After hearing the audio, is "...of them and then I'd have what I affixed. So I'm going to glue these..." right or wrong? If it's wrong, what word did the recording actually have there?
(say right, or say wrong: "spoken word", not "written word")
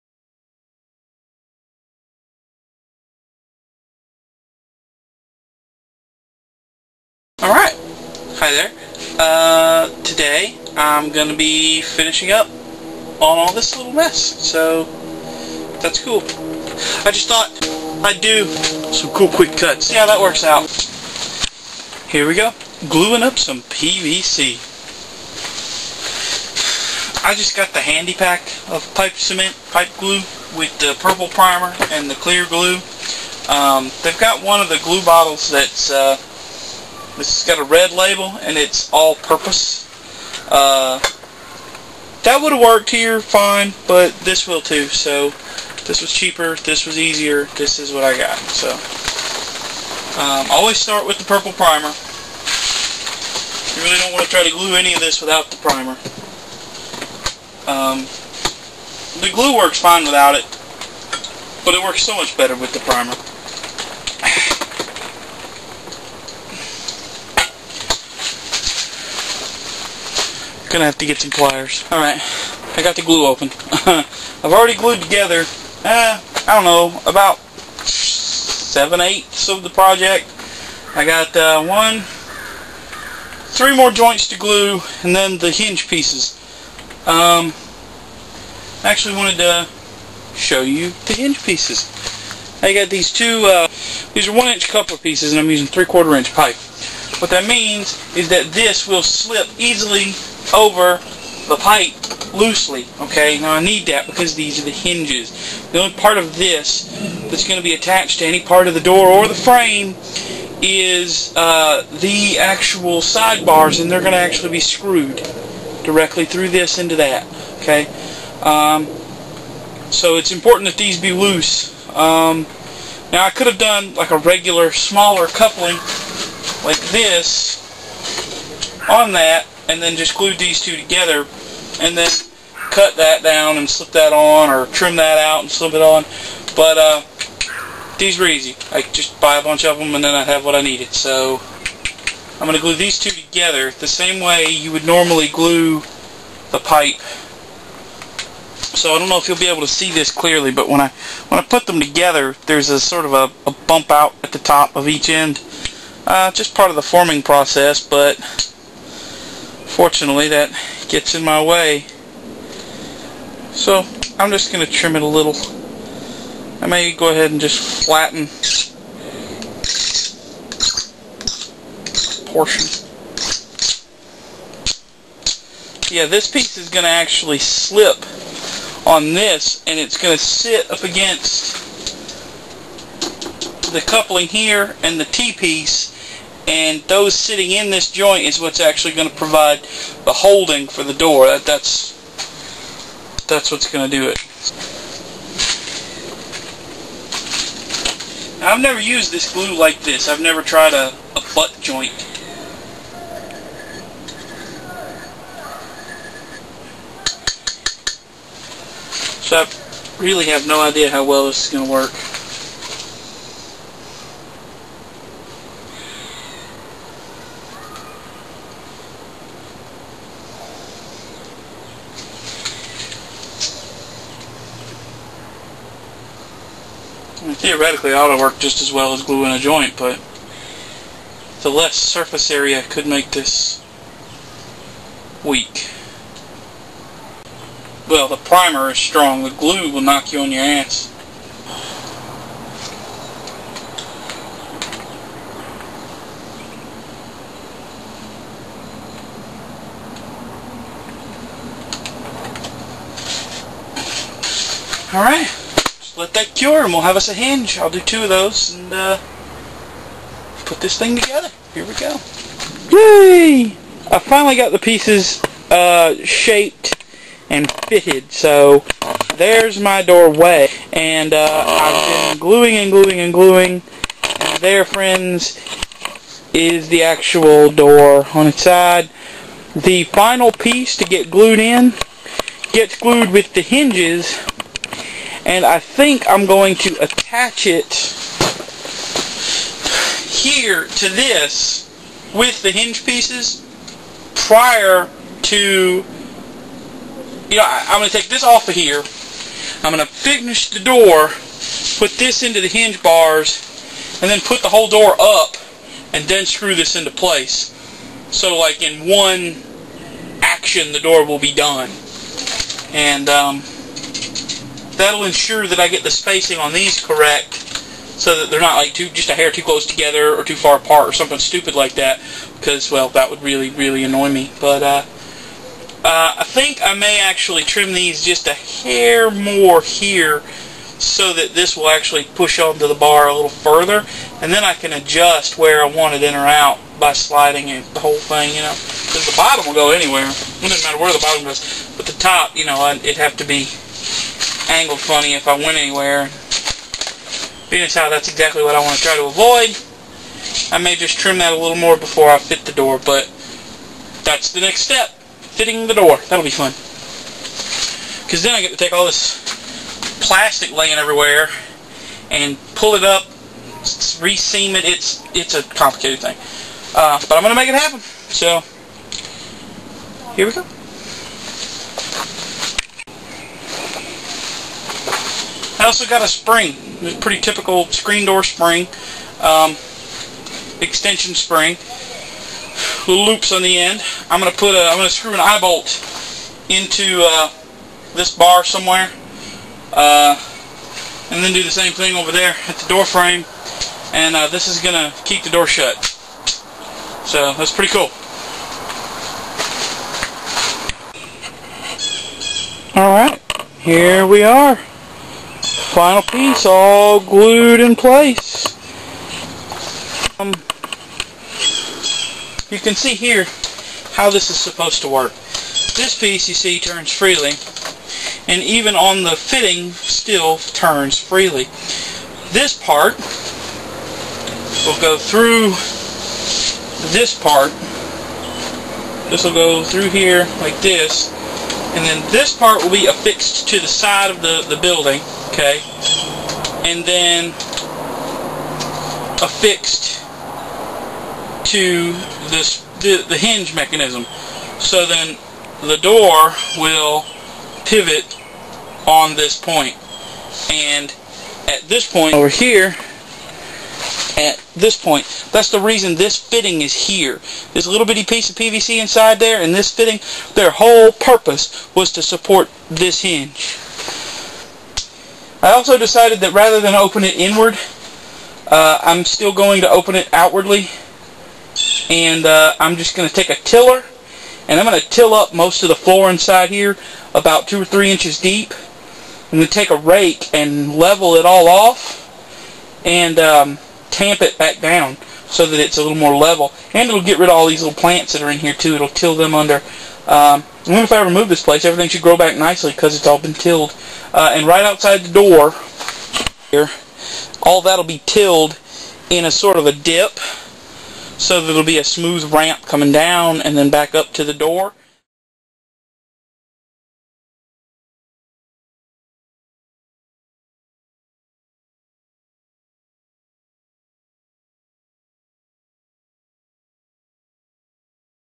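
wrong: "needed", not "affixed".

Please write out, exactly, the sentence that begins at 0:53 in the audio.
You really don't want to try to glue any of this without the primer.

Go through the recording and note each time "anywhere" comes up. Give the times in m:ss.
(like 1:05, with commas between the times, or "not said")
5:39, 5:45.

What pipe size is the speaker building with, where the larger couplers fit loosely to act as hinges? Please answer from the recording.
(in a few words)
3/4 inch.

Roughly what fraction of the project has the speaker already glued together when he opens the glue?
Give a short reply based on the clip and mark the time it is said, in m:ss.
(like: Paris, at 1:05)
seven-eighths, at 1:17.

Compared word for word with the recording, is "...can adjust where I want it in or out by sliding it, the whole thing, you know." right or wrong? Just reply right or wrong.
right.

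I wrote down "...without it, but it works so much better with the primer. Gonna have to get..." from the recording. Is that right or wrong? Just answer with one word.
right.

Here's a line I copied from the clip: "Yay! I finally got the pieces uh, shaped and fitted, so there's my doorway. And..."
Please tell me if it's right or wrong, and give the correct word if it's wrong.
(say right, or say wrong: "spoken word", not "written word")
right.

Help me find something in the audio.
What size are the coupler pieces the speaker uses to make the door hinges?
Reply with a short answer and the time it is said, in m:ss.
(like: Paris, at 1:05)
1 inch, at 1:34.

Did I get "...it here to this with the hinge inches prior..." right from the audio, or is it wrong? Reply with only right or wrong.
wrong.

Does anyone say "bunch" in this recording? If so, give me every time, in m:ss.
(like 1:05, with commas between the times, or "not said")
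2:19.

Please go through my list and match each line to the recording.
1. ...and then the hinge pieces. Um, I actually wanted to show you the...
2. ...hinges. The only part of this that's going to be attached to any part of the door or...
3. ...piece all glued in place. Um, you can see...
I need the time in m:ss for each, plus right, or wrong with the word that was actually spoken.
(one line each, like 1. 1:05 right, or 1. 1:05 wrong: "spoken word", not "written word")
1. 1:25 right
2. 1:44 right
3. 6:46 right.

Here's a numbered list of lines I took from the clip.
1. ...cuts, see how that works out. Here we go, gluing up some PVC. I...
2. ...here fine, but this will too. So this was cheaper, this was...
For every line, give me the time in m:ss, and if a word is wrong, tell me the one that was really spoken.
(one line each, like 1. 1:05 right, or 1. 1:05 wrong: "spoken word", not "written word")
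1. 0:19 right
2. 0:42 right.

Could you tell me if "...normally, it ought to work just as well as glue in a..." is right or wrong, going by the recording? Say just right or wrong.
wrong.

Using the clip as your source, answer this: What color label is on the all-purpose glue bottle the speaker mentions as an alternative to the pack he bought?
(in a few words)
red.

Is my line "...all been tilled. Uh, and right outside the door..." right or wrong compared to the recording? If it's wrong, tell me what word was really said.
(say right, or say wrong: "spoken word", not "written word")
right.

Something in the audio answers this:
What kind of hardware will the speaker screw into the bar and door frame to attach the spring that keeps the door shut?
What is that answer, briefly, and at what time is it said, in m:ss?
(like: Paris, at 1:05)
eye bolt, at 6:25.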